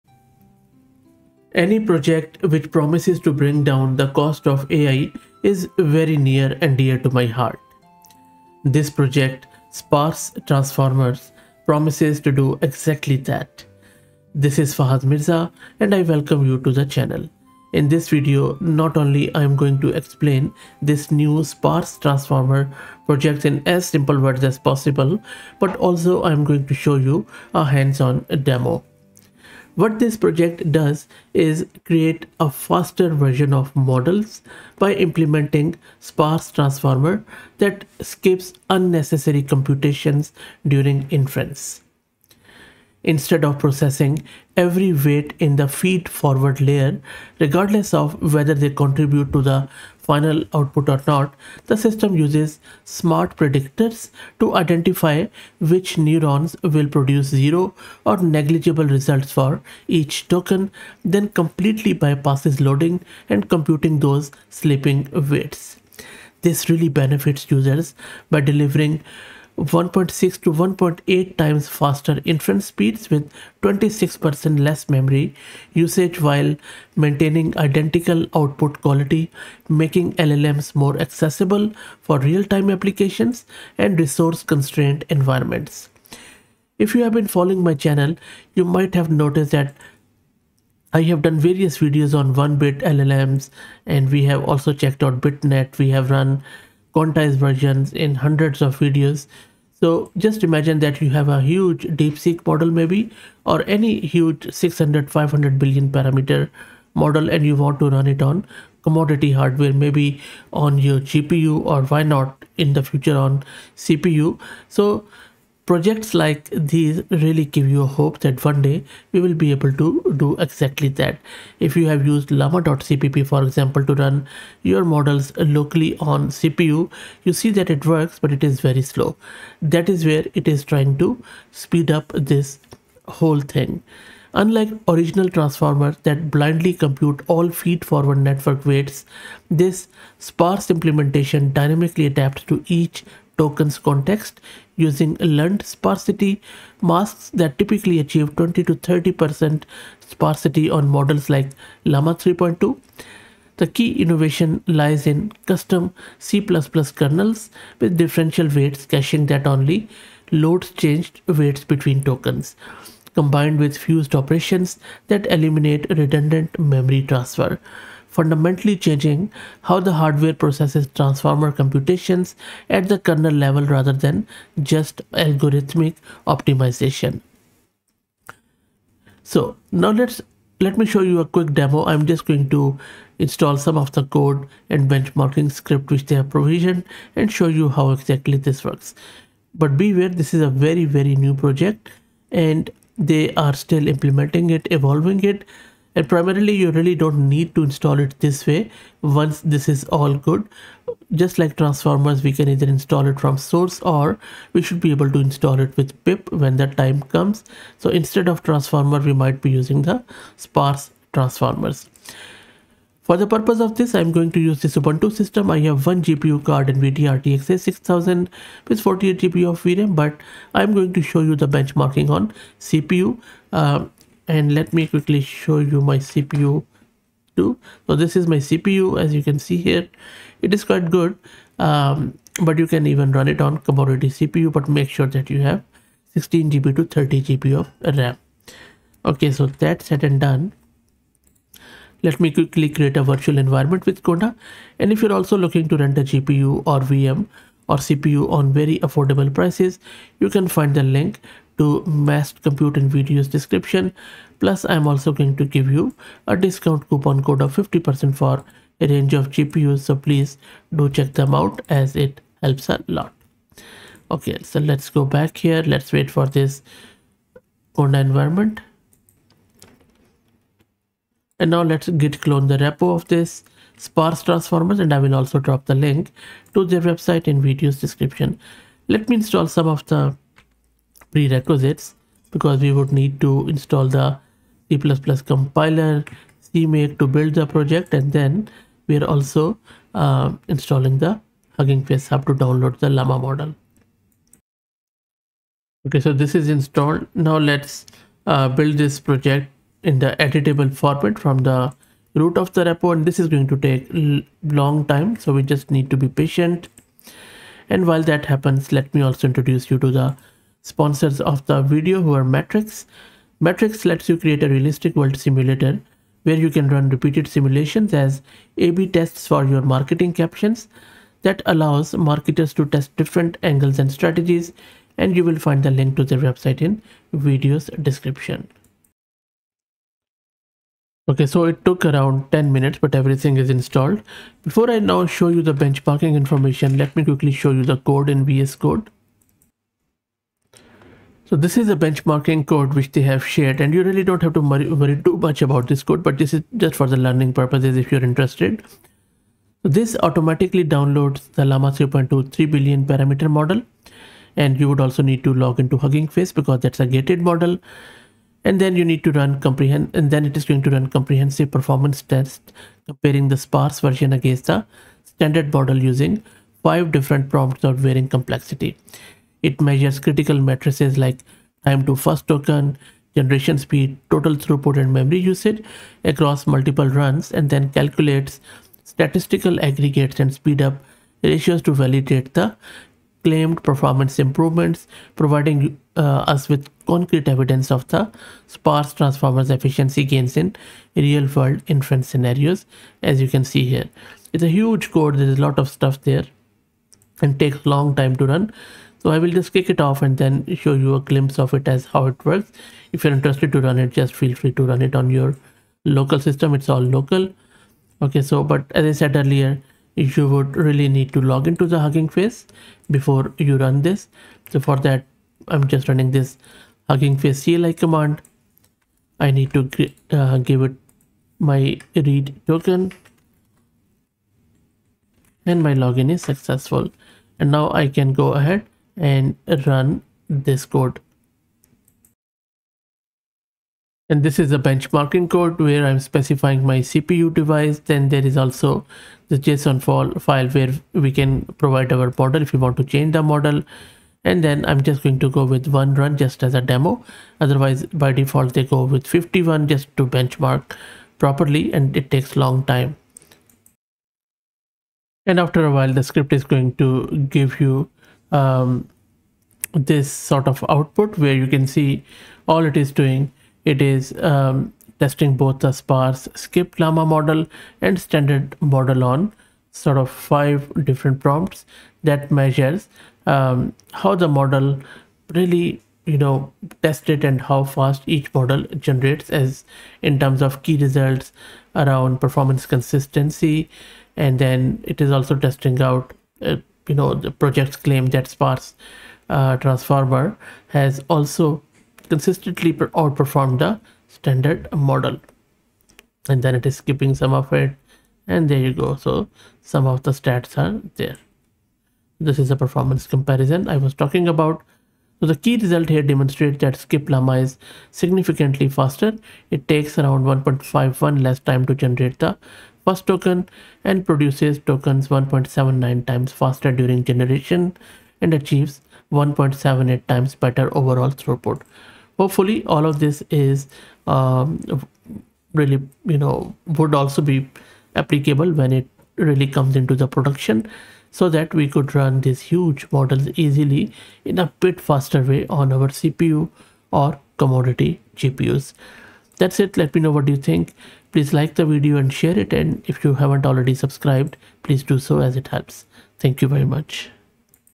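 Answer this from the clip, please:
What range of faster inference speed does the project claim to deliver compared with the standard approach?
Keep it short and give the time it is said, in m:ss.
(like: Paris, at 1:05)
1.6 to 1.8 times, at 1:09.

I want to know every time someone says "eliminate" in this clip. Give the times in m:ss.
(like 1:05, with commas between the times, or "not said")
2:45.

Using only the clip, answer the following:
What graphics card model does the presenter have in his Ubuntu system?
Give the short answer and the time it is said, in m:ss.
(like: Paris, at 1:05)
NVIDIA RTX 6000, at 3:36.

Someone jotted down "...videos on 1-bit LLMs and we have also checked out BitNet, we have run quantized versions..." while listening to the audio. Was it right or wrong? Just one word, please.
right.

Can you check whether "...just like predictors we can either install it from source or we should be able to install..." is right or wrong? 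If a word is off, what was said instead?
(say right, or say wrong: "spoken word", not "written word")
wrong: "transformers", not "predictors".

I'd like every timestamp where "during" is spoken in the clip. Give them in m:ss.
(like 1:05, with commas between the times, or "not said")
0:40, 8:36.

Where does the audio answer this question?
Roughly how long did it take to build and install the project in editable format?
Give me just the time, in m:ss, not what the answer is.
5:32.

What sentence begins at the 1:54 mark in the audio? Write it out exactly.
So projects like these really give you hope that one day we will be able to do exactly that.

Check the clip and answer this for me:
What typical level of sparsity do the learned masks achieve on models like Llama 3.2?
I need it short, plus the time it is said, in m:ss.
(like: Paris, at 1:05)
20 to 30%, at 2:28.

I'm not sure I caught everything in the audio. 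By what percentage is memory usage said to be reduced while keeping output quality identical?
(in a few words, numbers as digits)
26%.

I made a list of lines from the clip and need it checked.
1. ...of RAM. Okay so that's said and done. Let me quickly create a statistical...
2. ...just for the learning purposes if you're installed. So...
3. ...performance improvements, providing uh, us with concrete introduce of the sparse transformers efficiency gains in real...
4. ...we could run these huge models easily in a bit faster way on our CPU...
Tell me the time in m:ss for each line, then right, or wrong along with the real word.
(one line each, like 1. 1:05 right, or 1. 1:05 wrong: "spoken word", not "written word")
1. 3:57 wrong: "virtual", not "statistical"
2. 5:46 wrong: "interested", not "installed"
3. 6:23 wrong: "evidence", not "introduce"
4. 8:51 right.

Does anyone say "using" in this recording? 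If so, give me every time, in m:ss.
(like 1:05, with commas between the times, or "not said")
2:24, 3:29, 6:05.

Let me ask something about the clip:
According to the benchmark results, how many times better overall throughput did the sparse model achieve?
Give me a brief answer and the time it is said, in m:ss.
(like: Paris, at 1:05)
1.78 times, at 8:39.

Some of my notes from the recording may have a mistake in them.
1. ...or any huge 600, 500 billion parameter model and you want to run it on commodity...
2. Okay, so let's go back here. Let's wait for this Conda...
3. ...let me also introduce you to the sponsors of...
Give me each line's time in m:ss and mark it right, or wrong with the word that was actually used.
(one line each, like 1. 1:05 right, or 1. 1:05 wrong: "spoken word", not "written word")
1. 1:43 right
2. 4:24 right
3. 5:08 right.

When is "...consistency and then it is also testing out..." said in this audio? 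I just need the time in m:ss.
8:02.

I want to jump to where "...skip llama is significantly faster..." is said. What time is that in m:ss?
8:26.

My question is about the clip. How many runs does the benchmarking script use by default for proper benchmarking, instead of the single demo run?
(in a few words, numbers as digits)
51.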